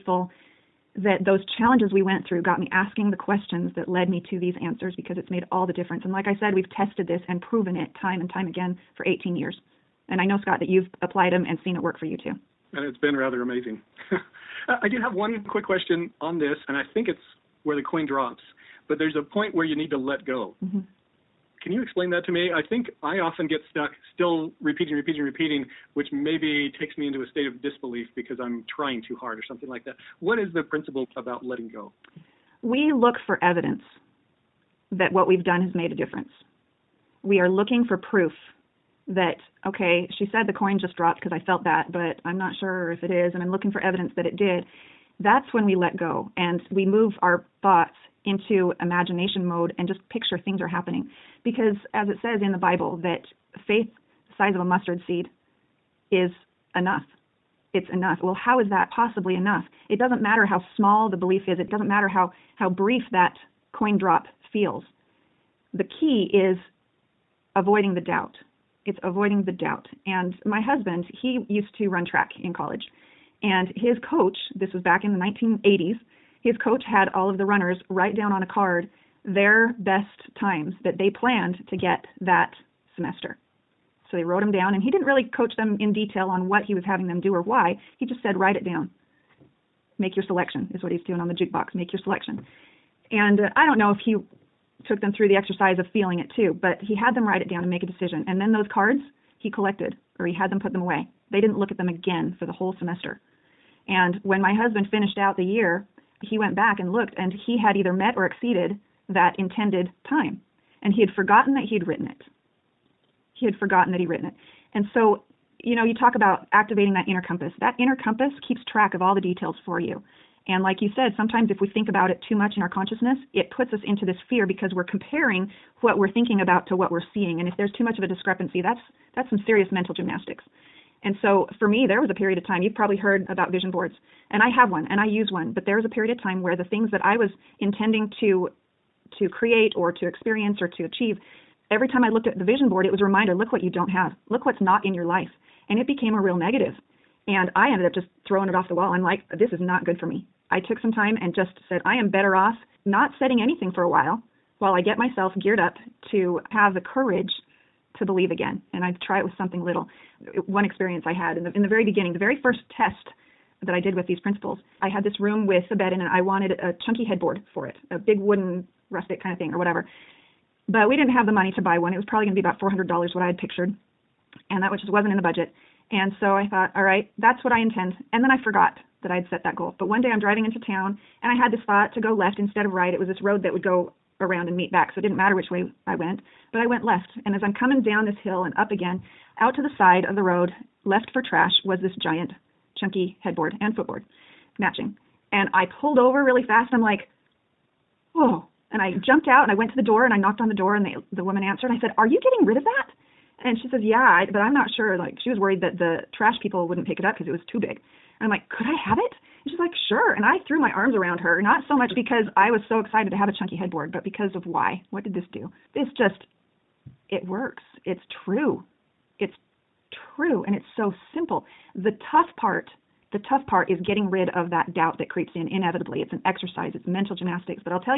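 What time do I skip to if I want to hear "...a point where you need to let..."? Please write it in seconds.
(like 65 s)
19 s.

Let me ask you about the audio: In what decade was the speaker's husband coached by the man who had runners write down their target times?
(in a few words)
1980s.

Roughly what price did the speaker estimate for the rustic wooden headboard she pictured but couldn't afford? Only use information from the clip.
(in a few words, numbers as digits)
$400.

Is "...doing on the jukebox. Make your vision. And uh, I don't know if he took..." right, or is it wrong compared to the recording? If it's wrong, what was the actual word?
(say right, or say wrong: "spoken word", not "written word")
wrong: "selection", not "vision".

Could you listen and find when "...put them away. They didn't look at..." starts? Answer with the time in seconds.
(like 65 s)
100 s.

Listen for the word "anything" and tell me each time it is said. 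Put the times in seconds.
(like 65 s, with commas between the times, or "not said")
153 s.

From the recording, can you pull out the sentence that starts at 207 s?
And I'm like, "Could I have it?" And she's like, sure.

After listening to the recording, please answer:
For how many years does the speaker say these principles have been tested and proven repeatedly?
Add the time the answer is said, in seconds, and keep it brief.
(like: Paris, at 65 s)
18 years, at 9 s.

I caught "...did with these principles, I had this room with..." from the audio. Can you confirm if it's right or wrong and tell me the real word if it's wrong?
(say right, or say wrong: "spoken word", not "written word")
right.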